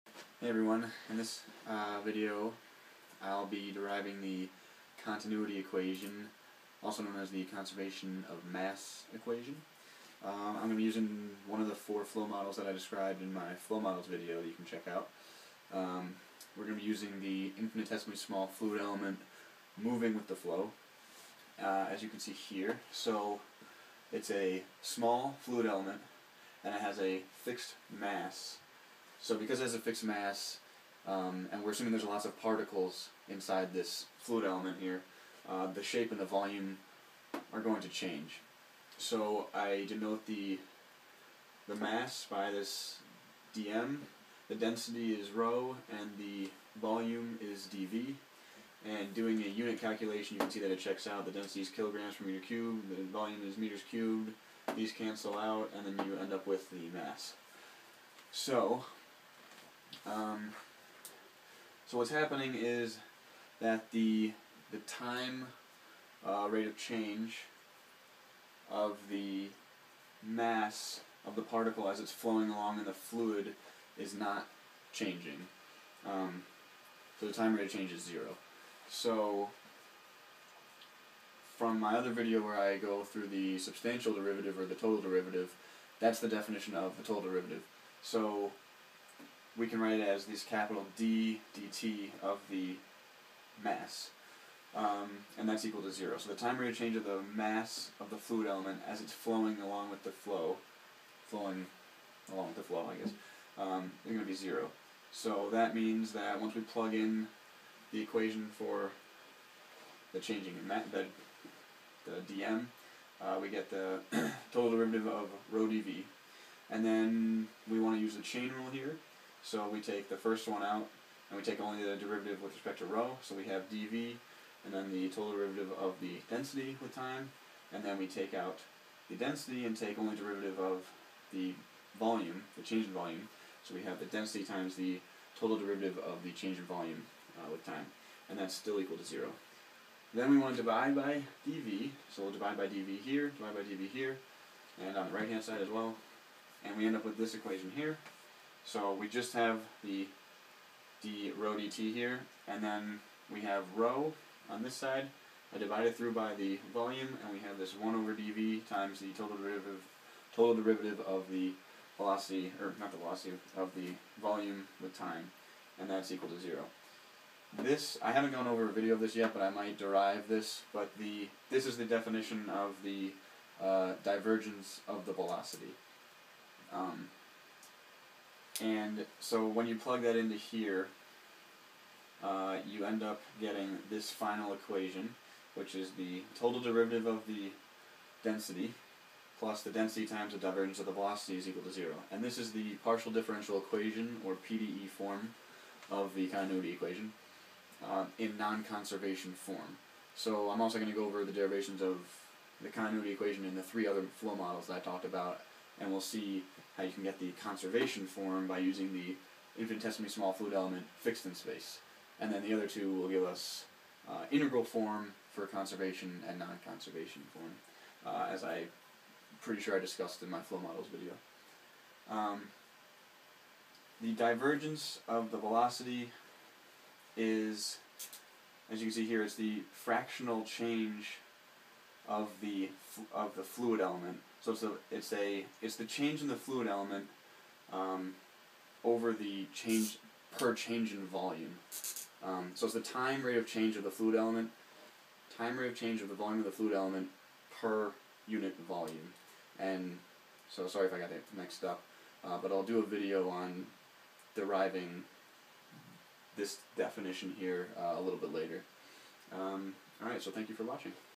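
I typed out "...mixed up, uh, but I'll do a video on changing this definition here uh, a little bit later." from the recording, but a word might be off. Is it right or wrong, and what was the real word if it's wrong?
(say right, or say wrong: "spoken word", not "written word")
wrong: "deriving", not "changing".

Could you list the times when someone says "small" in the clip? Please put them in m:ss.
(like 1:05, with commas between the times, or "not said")
0:18, 0:24, 3:30.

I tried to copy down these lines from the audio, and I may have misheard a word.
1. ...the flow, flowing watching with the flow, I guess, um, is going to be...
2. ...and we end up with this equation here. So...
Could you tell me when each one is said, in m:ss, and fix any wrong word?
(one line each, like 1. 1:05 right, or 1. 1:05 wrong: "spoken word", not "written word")
1. 1:40 wrong: "along", not "watching"
2. 2:26 right.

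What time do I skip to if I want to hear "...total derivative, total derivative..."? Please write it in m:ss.
2:39.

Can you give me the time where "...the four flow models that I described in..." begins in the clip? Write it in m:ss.
0:11.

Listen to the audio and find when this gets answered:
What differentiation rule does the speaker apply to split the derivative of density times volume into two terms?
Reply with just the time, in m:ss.
1:58.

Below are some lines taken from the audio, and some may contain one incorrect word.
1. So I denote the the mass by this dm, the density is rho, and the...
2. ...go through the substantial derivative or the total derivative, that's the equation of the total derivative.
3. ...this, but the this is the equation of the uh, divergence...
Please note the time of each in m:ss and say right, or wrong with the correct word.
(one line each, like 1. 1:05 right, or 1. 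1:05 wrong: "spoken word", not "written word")
1. 0:38 right
2. 1:22 wrong: "definition", not "equation"
3. 2:50 wrong: "definition", not "equation".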